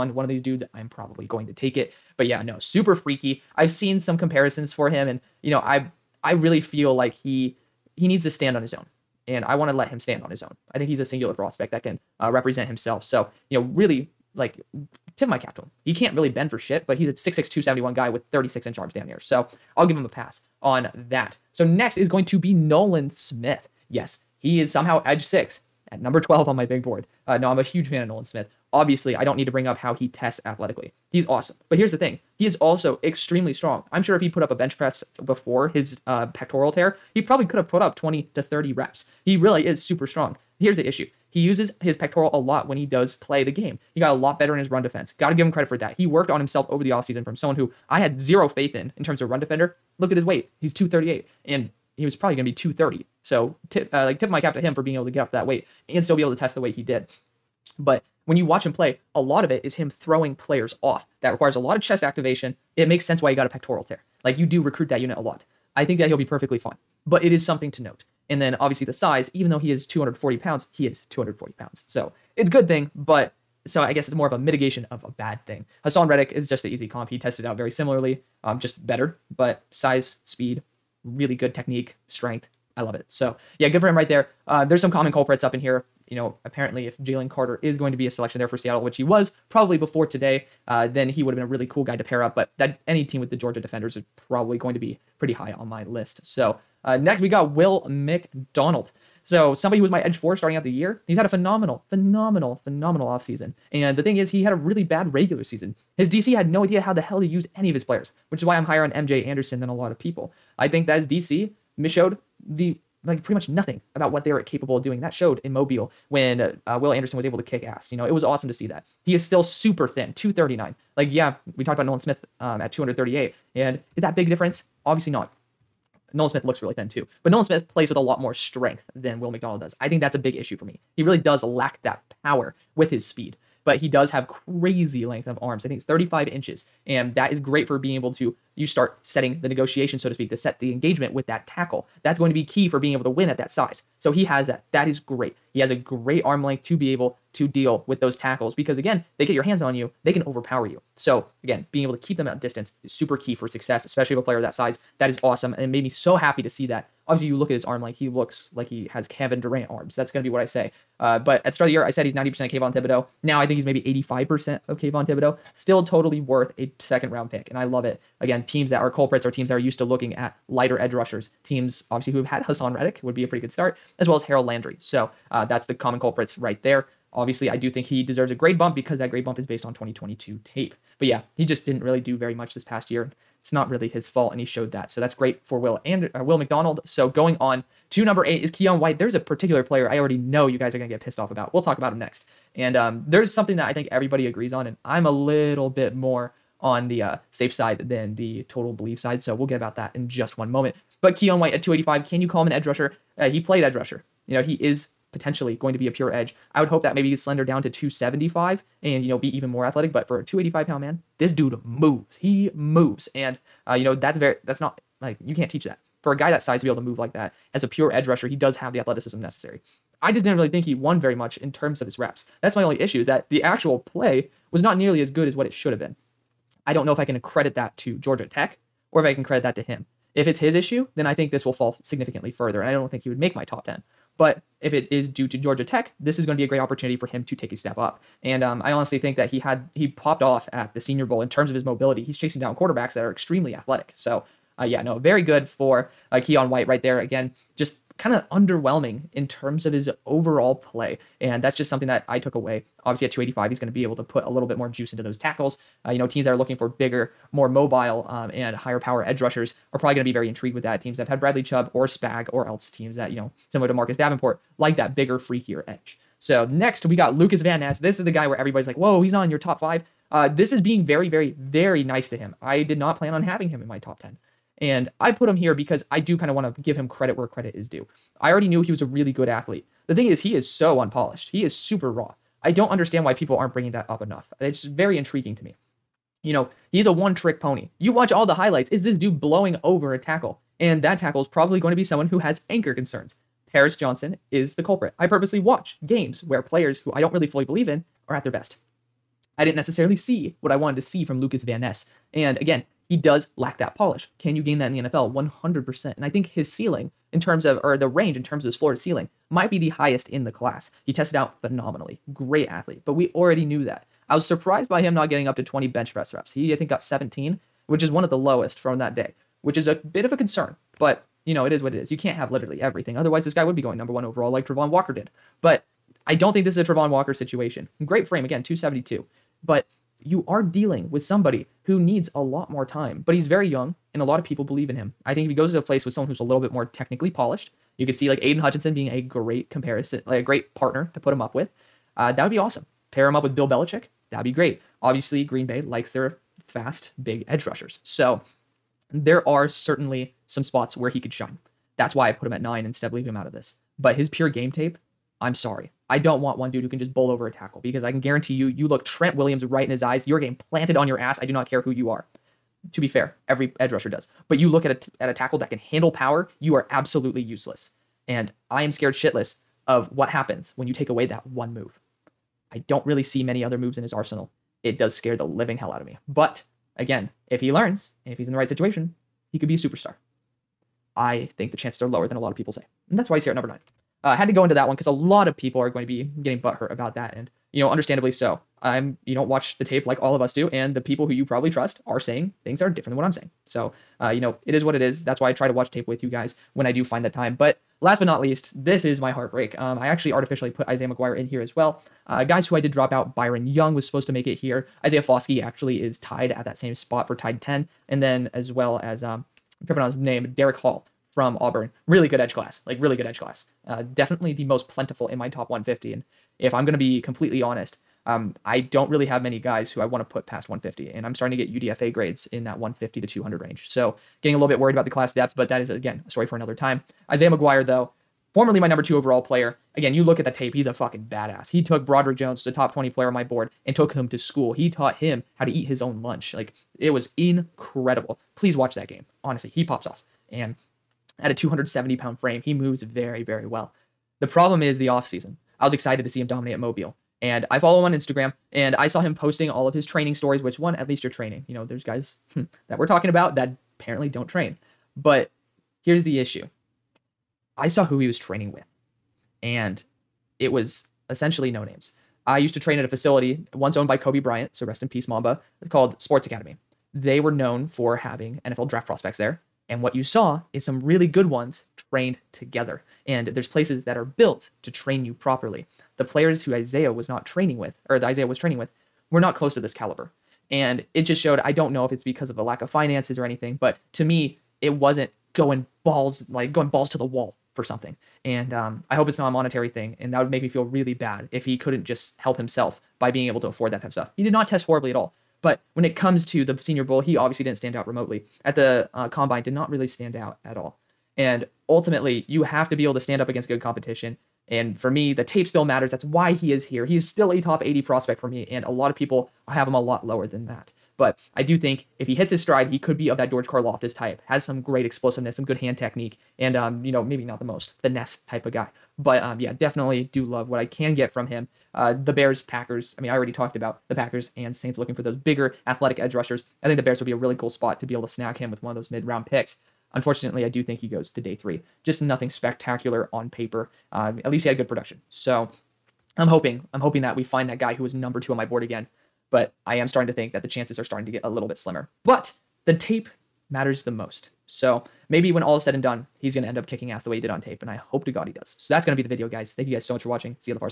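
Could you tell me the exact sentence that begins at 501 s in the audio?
And ultimately, you have to be able to stand up against good competition.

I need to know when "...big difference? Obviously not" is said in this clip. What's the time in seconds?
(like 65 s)
124 s.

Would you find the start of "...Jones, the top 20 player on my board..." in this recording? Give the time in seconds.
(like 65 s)
432 s.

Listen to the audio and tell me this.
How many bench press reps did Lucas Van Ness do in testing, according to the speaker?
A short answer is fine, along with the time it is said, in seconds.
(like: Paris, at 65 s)
17, at 316 s.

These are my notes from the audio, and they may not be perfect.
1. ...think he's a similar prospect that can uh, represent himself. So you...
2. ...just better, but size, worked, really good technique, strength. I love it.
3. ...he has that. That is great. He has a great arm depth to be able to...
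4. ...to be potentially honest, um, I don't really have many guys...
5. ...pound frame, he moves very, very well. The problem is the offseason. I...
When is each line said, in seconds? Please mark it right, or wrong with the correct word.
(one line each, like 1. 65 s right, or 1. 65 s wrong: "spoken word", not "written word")
1. 10 s wrong: "singular", not "similar"
2. 78 s wrong: "speed", not "worked"
3. 144 s wrong: "length", not "depth"
4. 416 s wrong: "completely", not "potentially"
5. 441 s right.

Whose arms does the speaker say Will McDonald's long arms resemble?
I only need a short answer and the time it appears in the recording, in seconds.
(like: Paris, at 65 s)
Kevin Durant, at 159 s.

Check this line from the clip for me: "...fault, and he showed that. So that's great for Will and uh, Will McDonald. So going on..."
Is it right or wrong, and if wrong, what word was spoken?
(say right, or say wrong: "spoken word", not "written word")
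right.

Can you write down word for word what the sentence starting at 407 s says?
And then as well as, um, I'm tripping on his name, Derick Hall from Auburn.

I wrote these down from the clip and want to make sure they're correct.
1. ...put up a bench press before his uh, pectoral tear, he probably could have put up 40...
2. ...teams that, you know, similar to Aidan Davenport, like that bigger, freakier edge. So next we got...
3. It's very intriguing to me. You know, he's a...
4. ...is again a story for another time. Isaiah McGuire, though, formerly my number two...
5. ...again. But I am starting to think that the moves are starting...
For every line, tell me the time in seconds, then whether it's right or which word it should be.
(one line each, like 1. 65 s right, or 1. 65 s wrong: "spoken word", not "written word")
1. 34 s wrong: "20", not "40"
2. 262 s wrong: "Marcus", not "Aidan"
3. 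284 s right
4. 425 s right
5. 538 s wrong: "chances", not "moves".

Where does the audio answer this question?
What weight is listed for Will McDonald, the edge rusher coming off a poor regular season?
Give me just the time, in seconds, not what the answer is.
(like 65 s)
120 s.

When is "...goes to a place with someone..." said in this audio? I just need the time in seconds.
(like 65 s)
335 s.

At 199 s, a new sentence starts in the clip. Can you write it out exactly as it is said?
So we'll get about that in just one moment.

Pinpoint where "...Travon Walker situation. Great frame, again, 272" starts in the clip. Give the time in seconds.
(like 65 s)
326 s.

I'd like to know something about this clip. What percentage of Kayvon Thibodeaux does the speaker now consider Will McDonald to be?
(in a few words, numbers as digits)
85%.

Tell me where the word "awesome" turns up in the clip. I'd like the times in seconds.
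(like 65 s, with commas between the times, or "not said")
31 s, 118 s, 155 s, 342 s.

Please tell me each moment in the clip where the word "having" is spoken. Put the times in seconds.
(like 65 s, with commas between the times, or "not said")
273 s, 467 s.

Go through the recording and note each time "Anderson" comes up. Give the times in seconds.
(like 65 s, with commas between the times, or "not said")
109 s, 116 s.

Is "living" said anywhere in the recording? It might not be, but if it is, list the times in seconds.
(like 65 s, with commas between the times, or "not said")
375 s.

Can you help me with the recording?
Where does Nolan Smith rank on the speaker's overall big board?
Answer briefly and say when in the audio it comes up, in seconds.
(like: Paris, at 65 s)
12, at 26 s.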